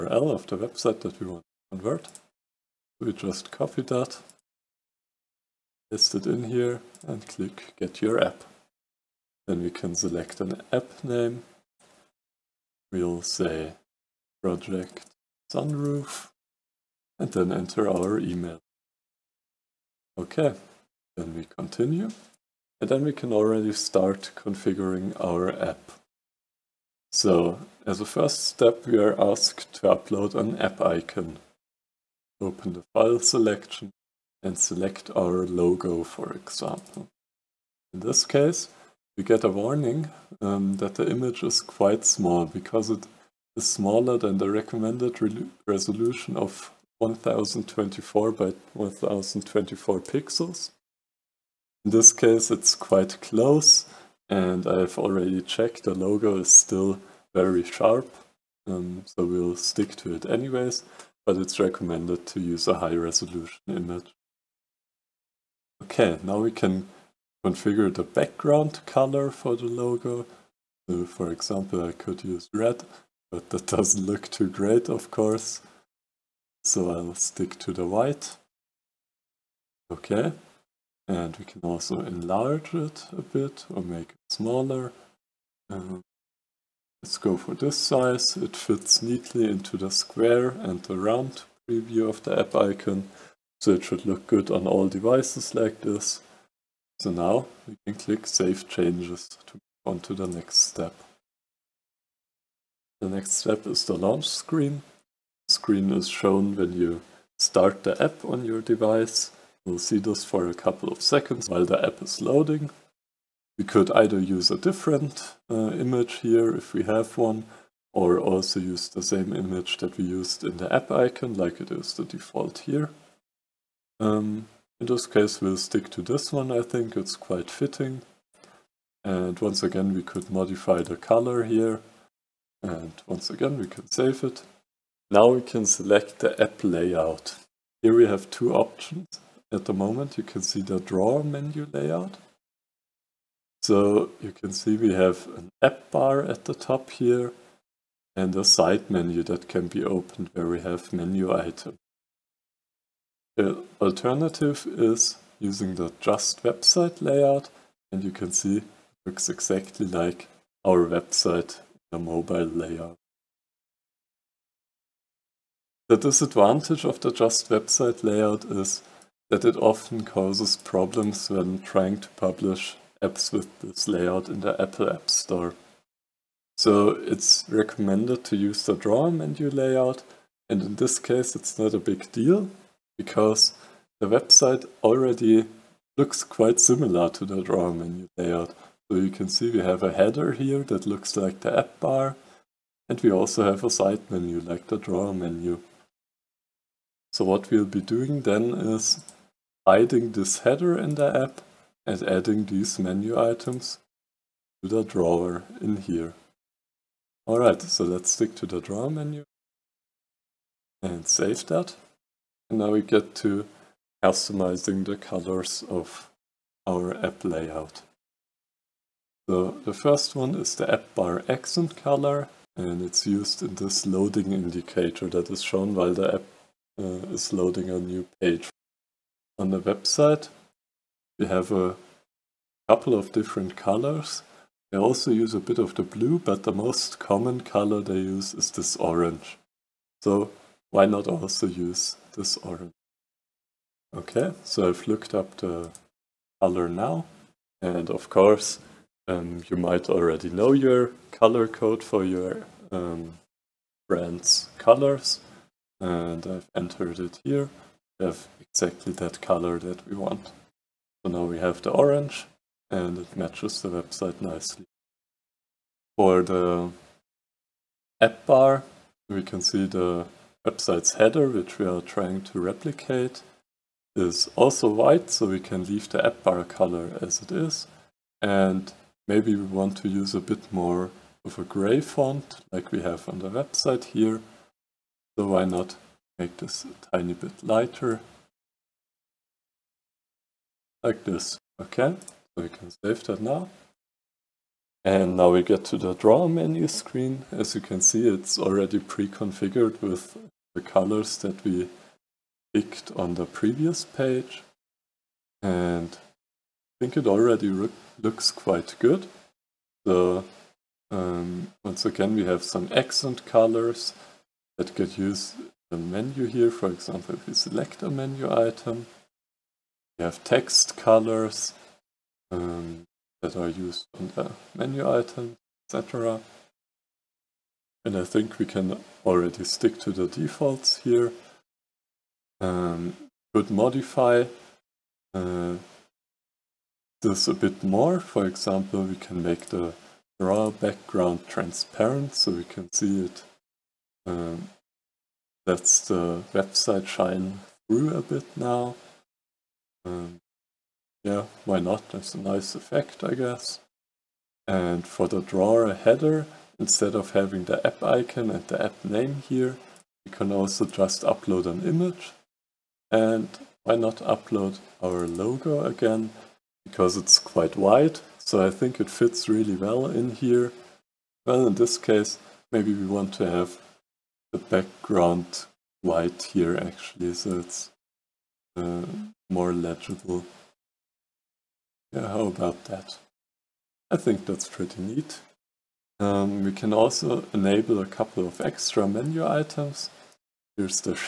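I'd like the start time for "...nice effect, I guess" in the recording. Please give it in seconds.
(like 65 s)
352 s.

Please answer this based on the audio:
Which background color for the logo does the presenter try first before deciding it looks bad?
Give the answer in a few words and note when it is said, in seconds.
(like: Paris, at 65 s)
Red, at 72 s.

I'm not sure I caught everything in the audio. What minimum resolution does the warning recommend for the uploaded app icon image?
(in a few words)
1024 by 1024 pixels.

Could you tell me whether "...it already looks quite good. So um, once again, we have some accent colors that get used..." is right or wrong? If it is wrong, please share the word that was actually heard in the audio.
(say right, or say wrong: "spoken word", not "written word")
right.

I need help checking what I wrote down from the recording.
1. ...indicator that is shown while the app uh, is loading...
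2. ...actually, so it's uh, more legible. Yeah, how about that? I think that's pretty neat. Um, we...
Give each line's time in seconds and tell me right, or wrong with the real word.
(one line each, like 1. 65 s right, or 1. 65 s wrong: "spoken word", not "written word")
1. 224 s right
2. 376 s right.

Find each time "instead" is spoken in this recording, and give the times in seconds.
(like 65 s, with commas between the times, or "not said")
356 s.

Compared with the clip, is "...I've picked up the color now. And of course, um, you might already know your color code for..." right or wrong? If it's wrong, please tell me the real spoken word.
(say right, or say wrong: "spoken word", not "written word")
wrong: "looked", not "picked".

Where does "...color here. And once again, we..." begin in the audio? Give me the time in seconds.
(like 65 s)
130 s.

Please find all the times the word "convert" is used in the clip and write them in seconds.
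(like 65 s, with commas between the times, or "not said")
1 s.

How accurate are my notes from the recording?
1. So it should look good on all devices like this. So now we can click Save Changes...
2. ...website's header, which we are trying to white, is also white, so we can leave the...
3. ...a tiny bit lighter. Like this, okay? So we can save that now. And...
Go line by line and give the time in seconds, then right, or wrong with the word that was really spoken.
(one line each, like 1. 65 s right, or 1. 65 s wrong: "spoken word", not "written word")
1. 93 s right
2. 270 s wrong: "replicate", not "white"
3. 286 s right.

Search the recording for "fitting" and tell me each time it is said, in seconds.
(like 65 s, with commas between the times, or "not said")
127 s.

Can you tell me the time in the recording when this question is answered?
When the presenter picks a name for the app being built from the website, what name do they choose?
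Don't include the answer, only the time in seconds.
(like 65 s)
14 s.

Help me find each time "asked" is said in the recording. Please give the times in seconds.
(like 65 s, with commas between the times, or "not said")
29 s.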